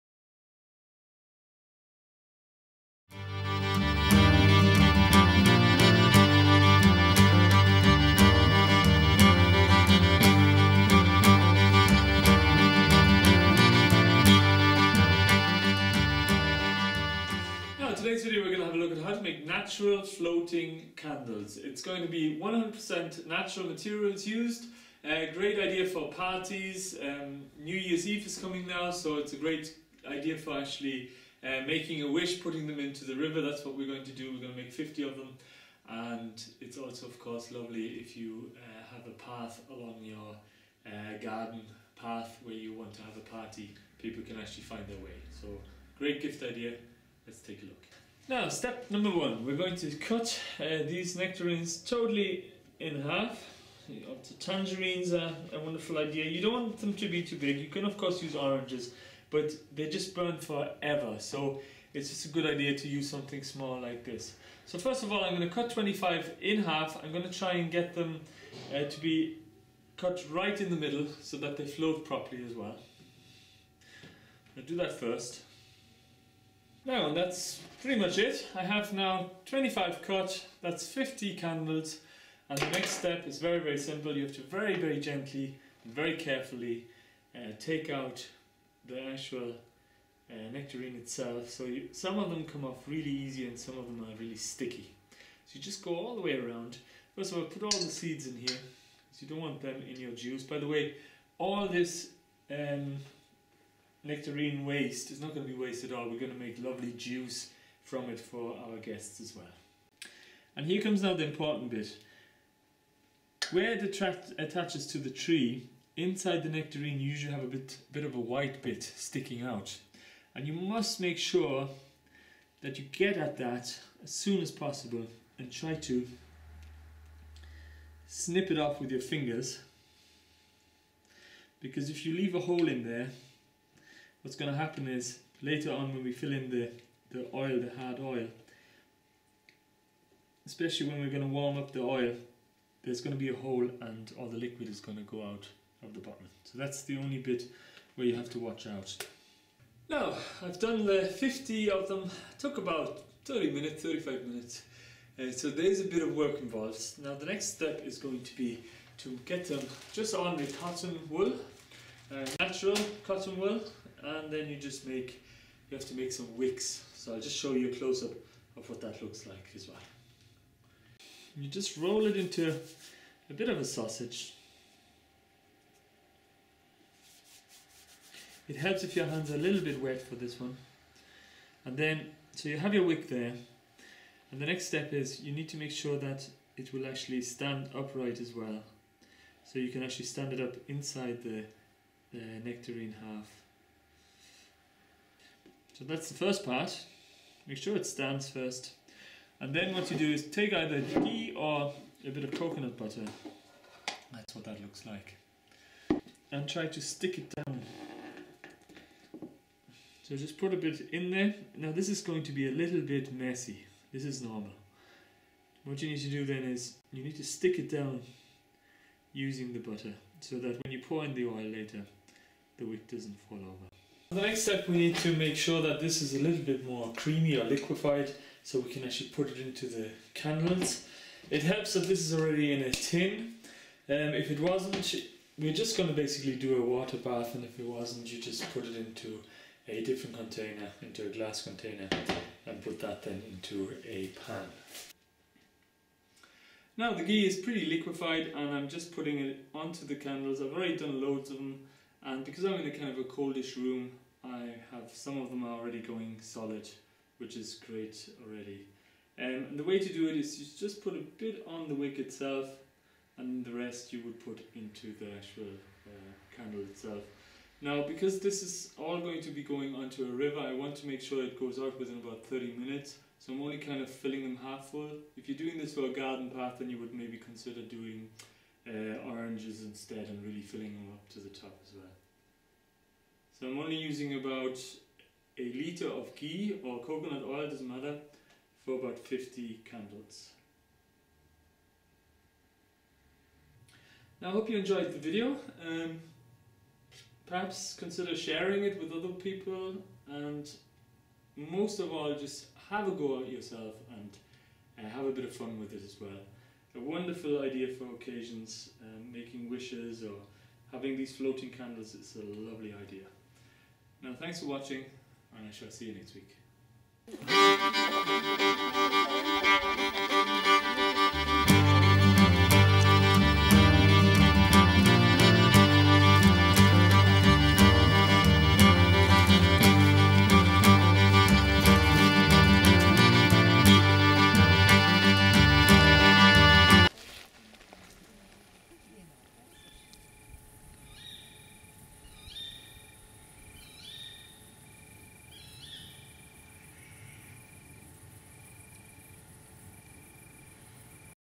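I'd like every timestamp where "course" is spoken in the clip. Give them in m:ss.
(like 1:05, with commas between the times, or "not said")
0:37, 0:57.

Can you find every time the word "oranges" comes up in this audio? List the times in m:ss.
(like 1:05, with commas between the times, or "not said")
0:58, 4:39.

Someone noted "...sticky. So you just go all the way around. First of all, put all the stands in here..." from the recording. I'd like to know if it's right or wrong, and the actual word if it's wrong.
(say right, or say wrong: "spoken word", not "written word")
wrong: "seeds", not "stands".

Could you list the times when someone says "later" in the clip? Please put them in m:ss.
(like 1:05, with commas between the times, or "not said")
2:15, 3:41.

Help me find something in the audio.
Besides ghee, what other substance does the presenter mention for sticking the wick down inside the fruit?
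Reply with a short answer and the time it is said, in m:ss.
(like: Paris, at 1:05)
coconut butter, at 3:22.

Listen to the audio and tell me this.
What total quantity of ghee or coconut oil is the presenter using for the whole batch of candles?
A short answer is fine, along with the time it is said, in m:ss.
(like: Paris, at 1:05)
1 liter, at 4:45.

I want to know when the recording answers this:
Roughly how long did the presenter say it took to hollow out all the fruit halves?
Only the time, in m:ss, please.
2:33.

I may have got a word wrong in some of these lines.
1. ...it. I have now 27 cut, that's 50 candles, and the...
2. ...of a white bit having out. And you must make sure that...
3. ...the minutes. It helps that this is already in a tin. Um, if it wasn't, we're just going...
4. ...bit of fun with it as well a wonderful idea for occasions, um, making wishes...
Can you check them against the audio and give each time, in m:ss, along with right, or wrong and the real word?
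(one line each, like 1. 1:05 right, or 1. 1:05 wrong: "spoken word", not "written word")
1. 1:18 wrong: "25", not "27"
2. 1:58 wrong: "sticking", not "having"
3. 3:49 wrong: "candles", not "minutes"
4. 5:05 right.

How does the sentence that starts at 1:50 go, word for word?
And here comes now the important bit.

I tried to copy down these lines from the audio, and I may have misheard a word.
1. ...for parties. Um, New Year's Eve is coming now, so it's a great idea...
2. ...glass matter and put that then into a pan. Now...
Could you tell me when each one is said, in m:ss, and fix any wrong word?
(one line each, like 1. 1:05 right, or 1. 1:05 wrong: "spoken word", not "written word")
1. 0:25 right
2. 4:01 wrong: "container", not "matter".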